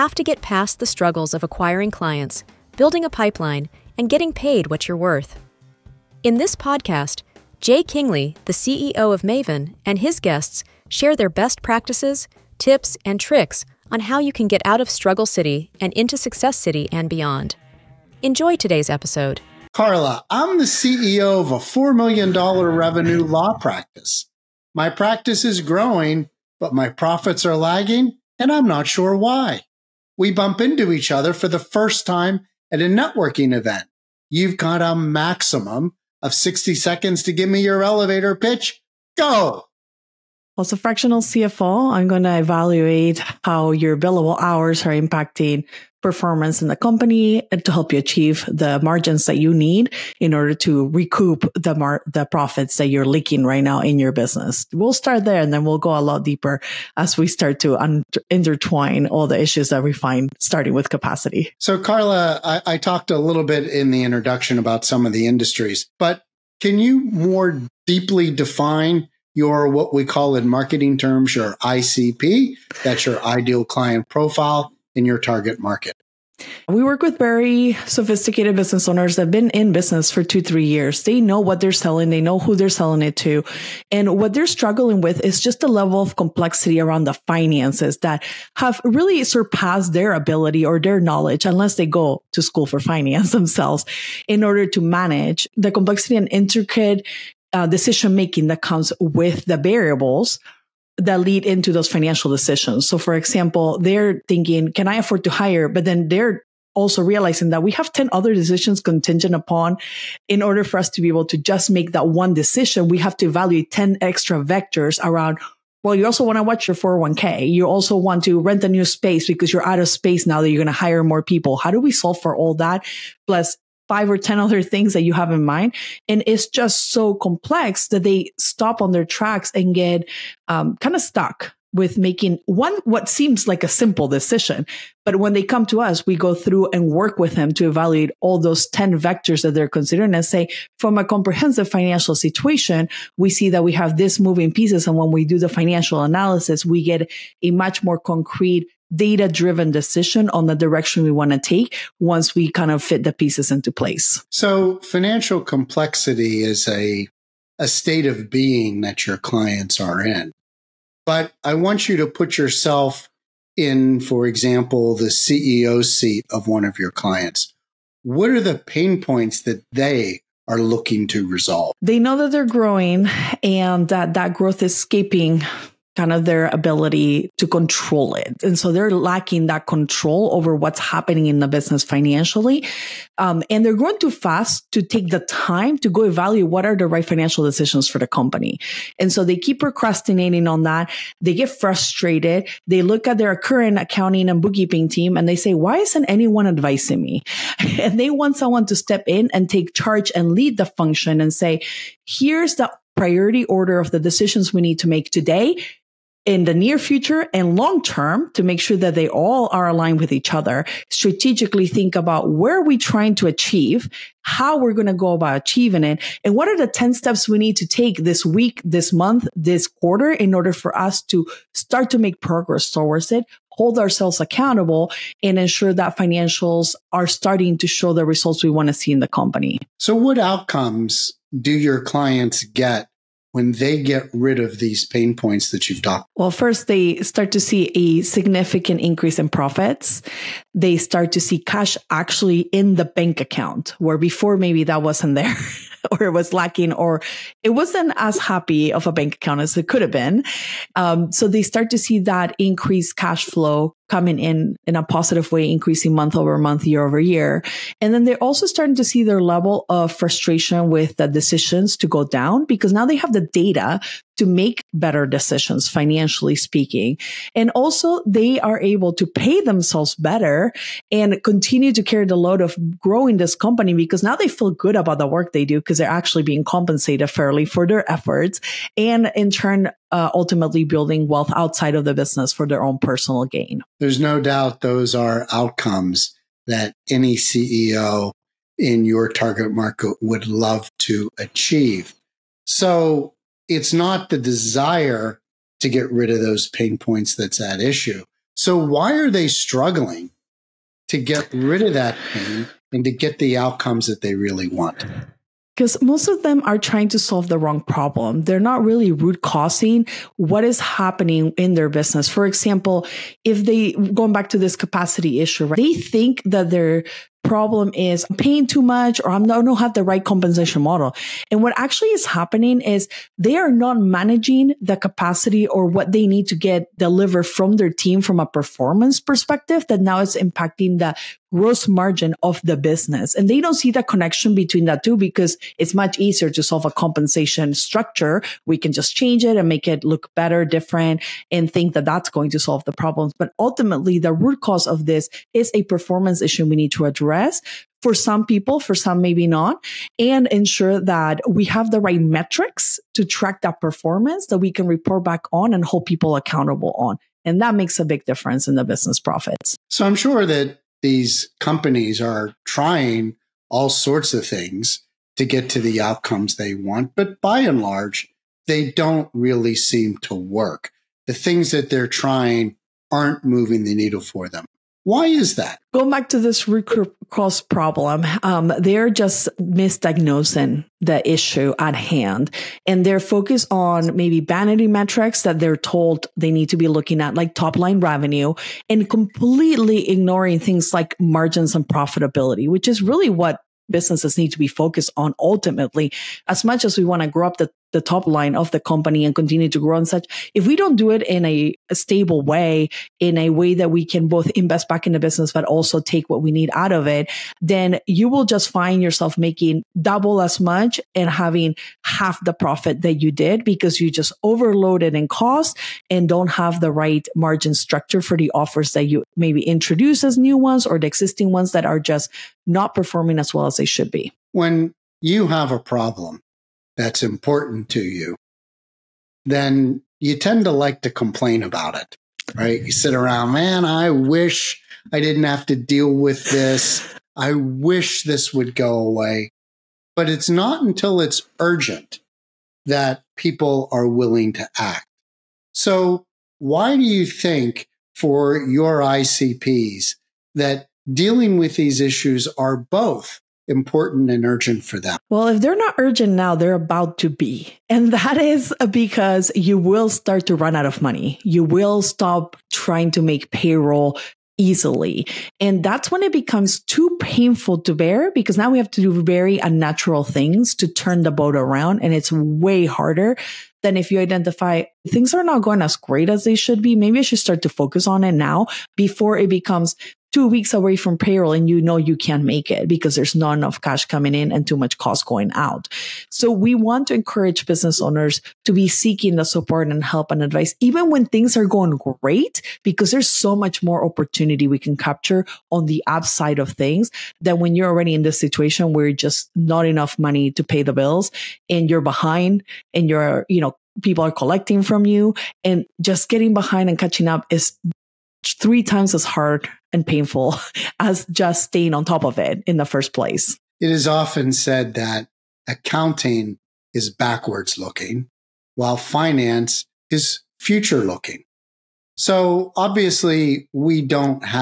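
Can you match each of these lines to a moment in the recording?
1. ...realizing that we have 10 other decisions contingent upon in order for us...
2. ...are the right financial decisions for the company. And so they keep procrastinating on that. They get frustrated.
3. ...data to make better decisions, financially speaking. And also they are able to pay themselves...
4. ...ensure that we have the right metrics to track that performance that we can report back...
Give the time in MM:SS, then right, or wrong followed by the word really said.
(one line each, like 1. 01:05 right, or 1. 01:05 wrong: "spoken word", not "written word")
1. 01:47 right
2. 03:06 right
3. 04:23 right
4. 05:50 right.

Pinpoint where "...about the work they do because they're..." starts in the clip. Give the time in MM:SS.
04:34.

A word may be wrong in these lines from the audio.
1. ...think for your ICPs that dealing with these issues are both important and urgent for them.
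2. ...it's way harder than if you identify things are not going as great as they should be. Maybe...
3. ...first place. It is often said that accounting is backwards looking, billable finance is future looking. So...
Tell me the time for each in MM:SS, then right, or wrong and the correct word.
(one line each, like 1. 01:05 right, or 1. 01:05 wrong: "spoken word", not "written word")
1. 07:27 right
2. 07:51 right
3. 08:32 wrong: "while", not "billable".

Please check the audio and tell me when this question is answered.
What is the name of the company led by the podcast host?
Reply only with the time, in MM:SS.
00:09.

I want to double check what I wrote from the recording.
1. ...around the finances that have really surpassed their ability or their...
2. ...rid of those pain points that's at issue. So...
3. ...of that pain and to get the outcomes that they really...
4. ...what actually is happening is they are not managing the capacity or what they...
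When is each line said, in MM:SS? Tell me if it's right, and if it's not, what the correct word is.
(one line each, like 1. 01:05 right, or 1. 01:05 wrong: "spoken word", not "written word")
1. 01:26 right
2. 04:55 right
3. 05:01 right
4. 05:21 right.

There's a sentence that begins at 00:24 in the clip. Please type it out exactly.
My practice is growing, but my profits are lagging, and I'm not sure why.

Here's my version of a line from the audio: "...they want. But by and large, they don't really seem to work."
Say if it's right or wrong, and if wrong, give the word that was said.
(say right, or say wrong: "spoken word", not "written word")
right.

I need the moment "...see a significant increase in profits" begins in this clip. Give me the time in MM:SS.
03:57.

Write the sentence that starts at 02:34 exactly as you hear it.
So financial complexity is a, a state of being that your clients are in.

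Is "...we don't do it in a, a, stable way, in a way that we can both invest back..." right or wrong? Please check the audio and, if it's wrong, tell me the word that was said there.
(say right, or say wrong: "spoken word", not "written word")
right.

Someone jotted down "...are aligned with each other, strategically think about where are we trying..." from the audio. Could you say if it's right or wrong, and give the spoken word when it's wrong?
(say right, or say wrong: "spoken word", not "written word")
right.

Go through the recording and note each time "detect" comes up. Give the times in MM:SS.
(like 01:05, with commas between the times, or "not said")
not said.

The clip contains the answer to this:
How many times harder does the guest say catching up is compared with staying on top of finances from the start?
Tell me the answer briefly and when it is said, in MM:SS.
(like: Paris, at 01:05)
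Three times, at 08:28.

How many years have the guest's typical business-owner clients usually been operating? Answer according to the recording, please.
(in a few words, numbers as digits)
Two, three years.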